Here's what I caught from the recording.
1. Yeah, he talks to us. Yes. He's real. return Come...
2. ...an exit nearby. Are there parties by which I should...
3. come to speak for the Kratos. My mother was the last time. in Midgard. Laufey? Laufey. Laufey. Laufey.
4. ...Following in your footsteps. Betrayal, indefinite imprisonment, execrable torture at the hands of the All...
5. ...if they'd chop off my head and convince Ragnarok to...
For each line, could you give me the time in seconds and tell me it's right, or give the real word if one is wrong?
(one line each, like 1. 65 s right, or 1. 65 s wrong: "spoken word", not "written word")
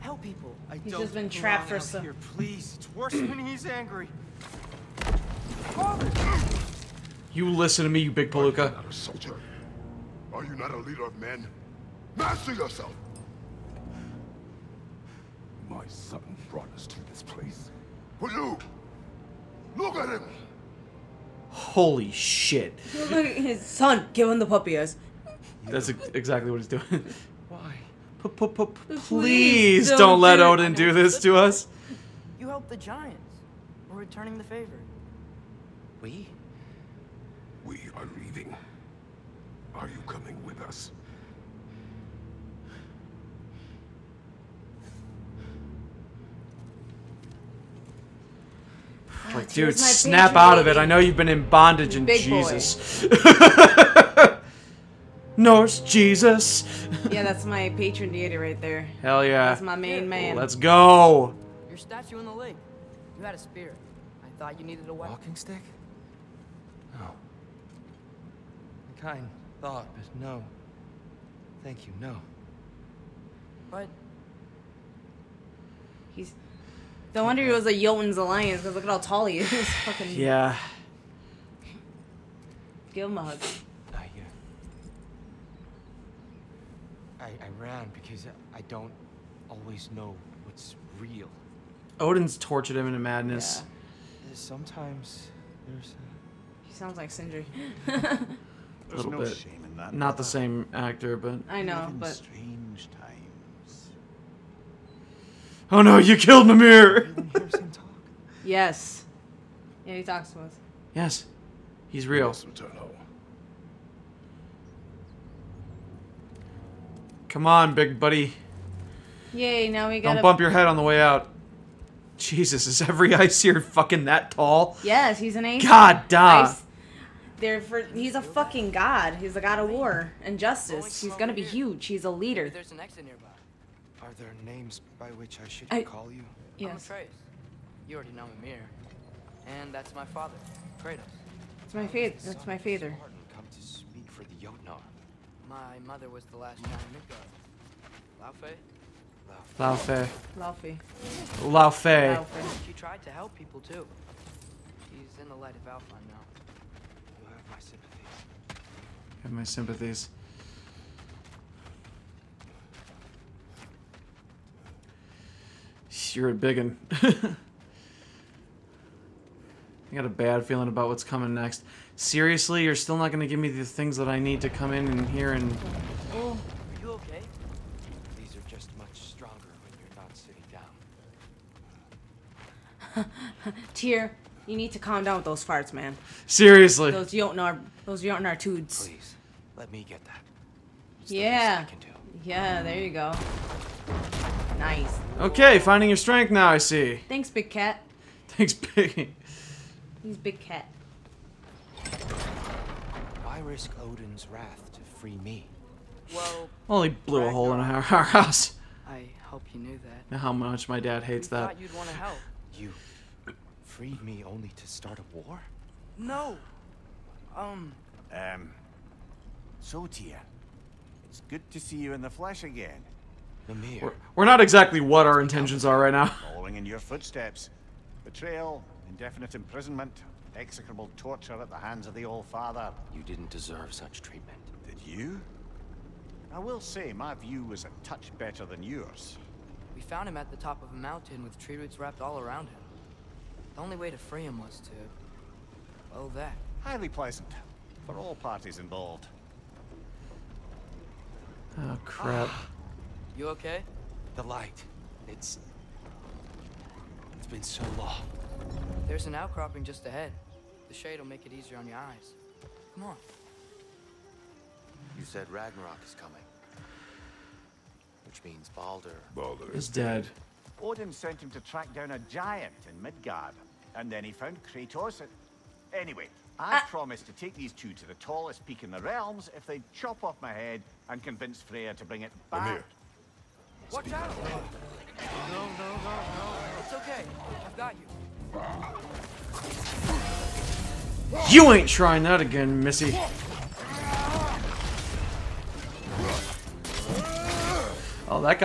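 1. 109 s right
2. 132 s wrong: "names", not "parties"
3. 143 s wrong: "Jotnar", not "Kratos"
4. 226 s right
5. 279 s wrong: "Freya", not "Ragnarok".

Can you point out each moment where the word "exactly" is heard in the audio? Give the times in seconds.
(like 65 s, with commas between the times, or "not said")
25 s, 224 s.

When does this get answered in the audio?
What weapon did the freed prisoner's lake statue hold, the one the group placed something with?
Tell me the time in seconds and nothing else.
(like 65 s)
63 s.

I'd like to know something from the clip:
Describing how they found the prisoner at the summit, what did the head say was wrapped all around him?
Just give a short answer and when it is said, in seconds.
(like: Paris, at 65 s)
Tree roots, at 241 s.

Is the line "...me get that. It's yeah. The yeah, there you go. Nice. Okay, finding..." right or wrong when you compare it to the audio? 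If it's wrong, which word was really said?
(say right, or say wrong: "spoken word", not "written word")
right.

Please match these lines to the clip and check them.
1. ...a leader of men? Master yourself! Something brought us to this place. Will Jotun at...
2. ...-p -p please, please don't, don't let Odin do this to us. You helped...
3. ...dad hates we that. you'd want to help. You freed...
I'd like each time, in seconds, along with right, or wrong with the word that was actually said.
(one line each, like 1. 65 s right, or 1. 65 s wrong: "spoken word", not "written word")
1. 10 s wrong: "Look", not "Jotun"
2. 28 s right
3. 210 s right.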